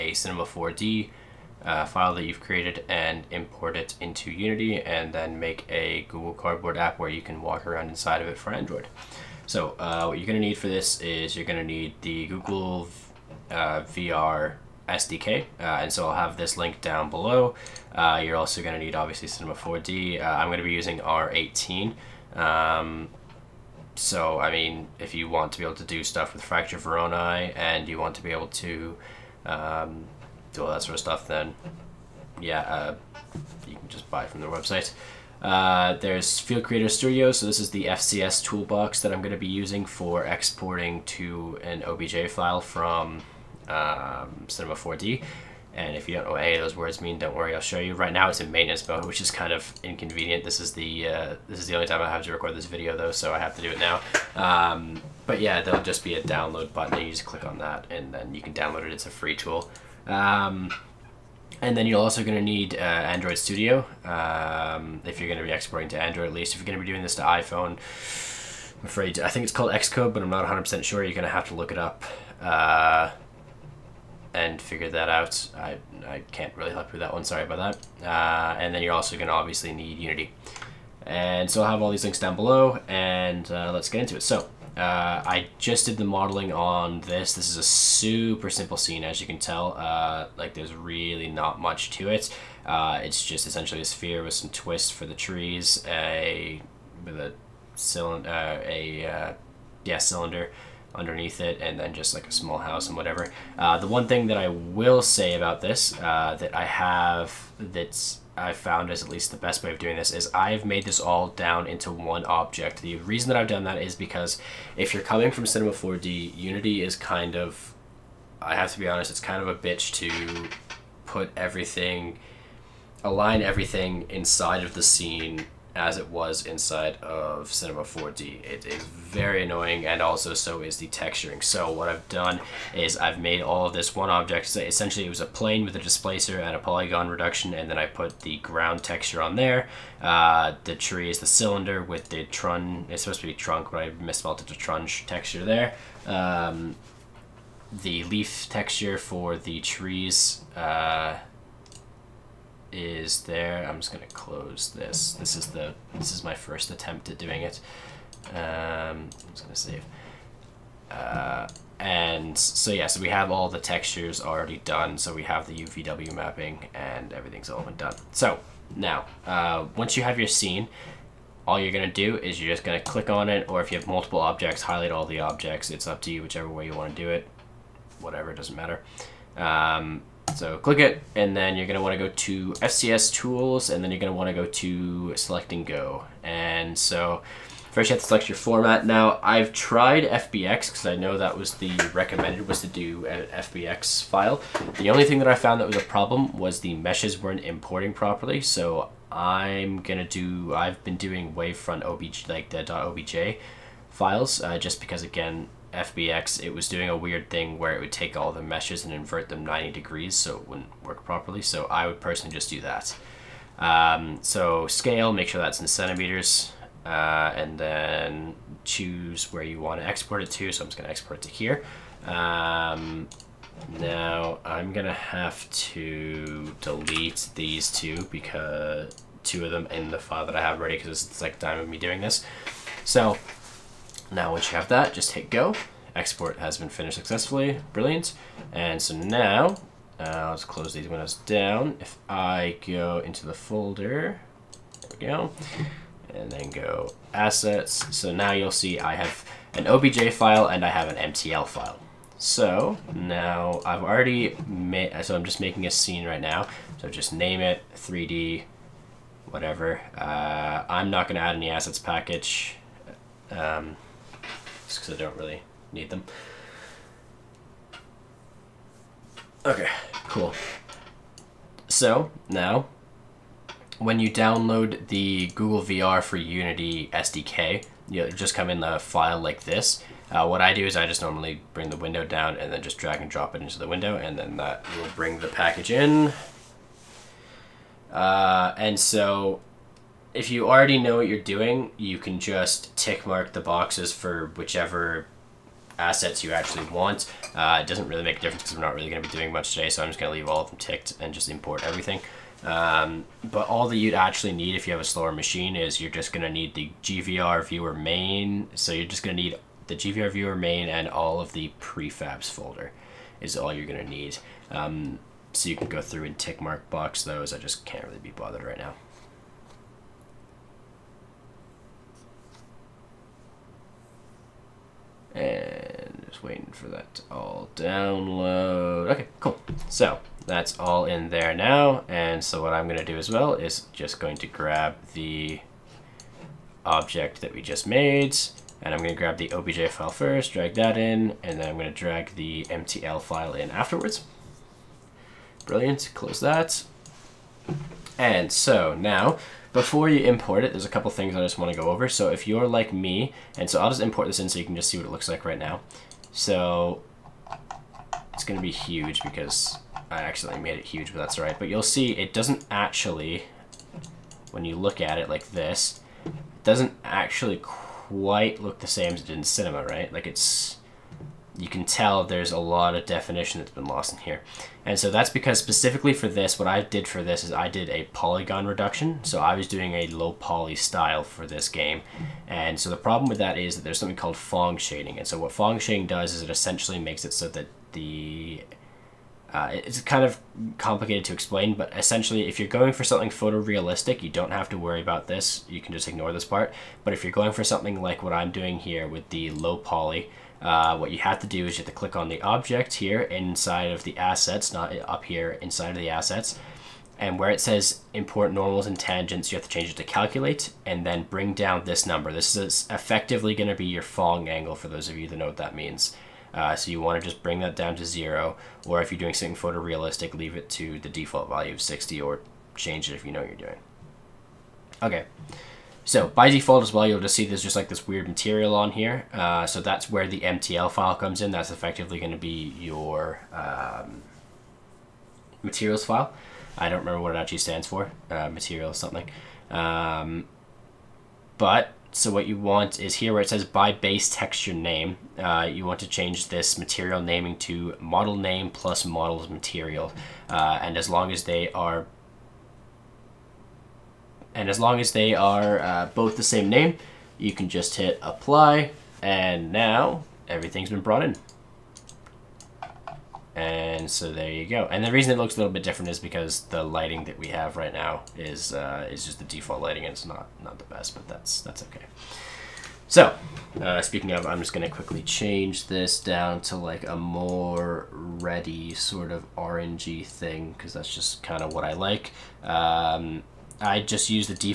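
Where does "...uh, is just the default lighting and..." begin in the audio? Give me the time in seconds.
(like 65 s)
468 s.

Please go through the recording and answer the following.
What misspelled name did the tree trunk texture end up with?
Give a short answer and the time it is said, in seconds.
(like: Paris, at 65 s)
trunch, at 144 s.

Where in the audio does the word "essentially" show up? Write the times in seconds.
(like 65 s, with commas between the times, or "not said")
93 s, 134 s, 386 s, 391 s.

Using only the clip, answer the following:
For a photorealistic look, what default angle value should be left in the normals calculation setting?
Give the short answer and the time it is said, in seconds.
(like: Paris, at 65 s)
60, at 421 s.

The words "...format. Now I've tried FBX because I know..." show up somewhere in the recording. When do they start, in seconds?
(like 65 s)
188 s.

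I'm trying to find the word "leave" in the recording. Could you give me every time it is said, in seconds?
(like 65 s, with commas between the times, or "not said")
300 s, 420 s.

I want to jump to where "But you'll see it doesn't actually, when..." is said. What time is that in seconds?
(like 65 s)
361 s.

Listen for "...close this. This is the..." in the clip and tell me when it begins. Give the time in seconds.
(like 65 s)
154 s.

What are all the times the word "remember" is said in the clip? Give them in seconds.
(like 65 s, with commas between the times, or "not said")
436 s.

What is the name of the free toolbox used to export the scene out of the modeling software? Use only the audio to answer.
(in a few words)
FCS toolbox.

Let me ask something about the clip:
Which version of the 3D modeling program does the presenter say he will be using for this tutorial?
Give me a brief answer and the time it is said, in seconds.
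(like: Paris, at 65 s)
R18, at 20 s.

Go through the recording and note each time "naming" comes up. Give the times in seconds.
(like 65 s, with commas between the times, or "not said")
446 s.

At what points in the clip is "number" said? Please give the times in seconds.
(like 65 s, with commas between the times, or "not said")
411 s.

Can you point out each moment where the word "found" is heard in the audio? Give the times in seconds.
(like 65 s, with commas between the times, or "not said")
108 s, 195 s.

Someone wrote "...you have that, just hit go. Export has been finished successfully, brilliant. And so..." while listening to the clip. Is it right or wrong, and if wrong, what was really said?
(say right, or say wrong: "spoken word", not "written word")
right.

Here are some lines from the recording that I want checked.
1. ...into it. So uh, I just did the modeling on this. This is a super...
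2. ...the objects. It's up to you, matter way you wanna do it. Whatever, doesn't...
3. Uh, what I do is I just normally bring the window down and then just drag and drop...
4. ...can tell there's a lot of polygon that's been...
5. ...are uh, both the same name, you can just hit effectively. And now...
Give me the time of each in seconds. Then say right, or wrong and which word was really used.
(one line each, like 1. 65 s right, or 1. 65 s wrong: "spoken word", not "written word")
1. 84 s right
2. 175 s wrong: "whichever", not "matter"
3. 280 s right
4. 371 s wrong: "definition", not "polygon"
5. 455 s wrong: "apply", not "effectively".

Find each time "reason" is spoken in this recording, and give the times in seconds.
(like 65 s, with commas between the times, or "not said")
112 s, 464 s.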